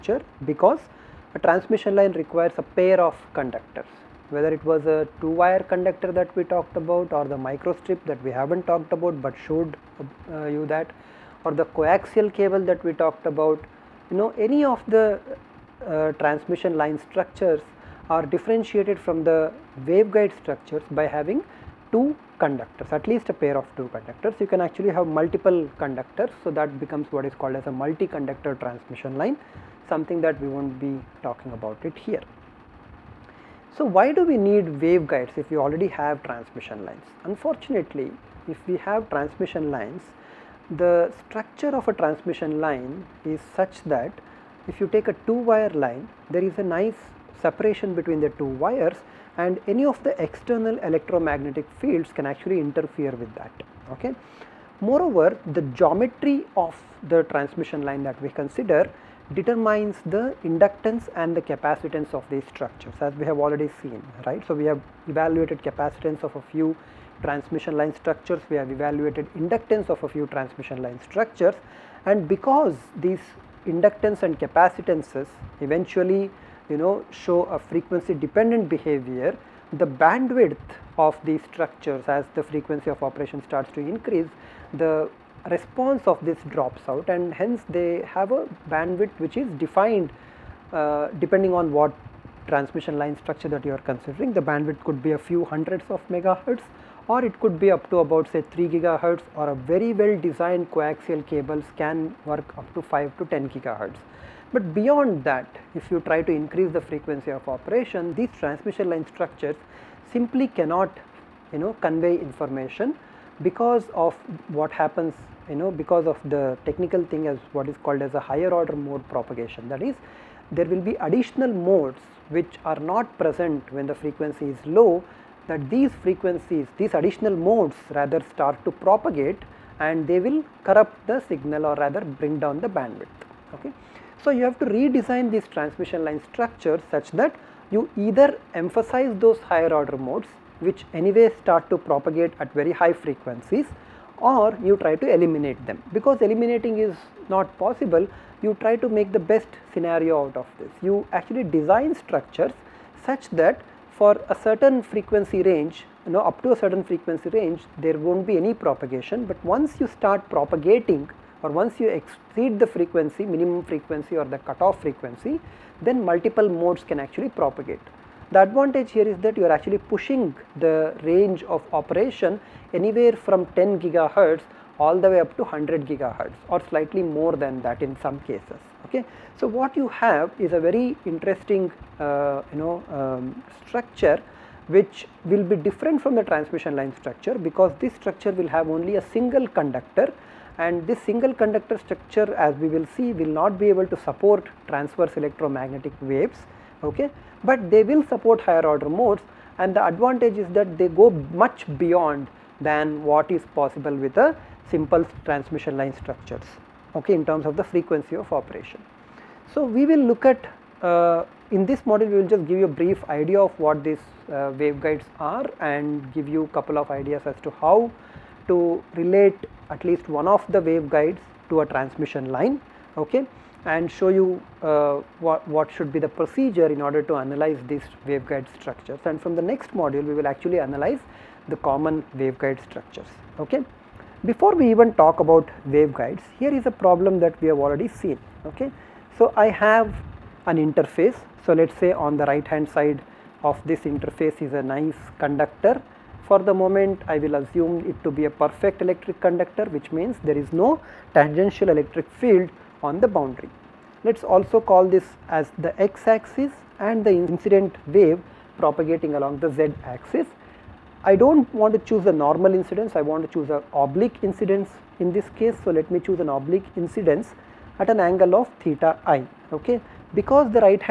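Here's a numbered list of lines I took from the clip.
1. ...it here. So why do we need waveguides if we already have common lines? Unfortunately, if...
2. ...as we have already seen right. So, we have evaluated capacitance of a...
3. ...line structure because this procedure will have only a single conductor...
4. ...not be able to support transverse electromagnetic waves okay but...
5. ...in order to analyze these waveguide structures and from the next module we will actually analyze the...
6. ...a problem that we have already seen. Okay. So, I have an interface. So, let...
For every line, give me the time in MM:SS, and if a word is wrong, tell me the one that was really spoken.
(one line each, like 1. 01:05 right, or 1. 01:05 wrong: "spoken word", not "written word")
1. 00:31 wrong: "transmission", not "common"
2. 01:02 right
3. 03:06 wrong: "structure", not "procedure"
4. 03:13 right
5. 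03:46 right
6. 03:56 right.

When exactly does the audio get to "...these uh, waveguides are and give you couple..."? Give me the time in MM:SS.
03:33.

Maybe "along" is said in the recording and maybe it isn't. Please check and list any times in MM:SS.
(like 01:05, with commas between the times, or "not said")
04:19.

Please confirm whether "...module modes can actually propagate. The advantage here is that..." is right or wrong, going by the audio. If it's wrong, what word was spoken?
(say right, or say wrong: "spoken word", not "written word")
wrong: "multiple", not "module".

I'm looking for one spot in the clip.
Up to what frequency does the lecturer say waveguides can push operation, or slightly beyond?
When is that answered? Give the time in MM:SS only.
02:55.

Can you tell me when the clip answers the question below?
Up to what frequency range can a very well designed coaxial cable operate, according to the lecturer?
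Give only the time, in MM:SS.
01:42.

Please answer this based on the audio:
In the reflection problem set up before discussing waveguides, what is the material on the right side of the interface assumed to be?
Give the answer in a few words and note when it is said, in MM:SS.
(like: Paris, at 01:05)
perfect electric conductor, at 04:08.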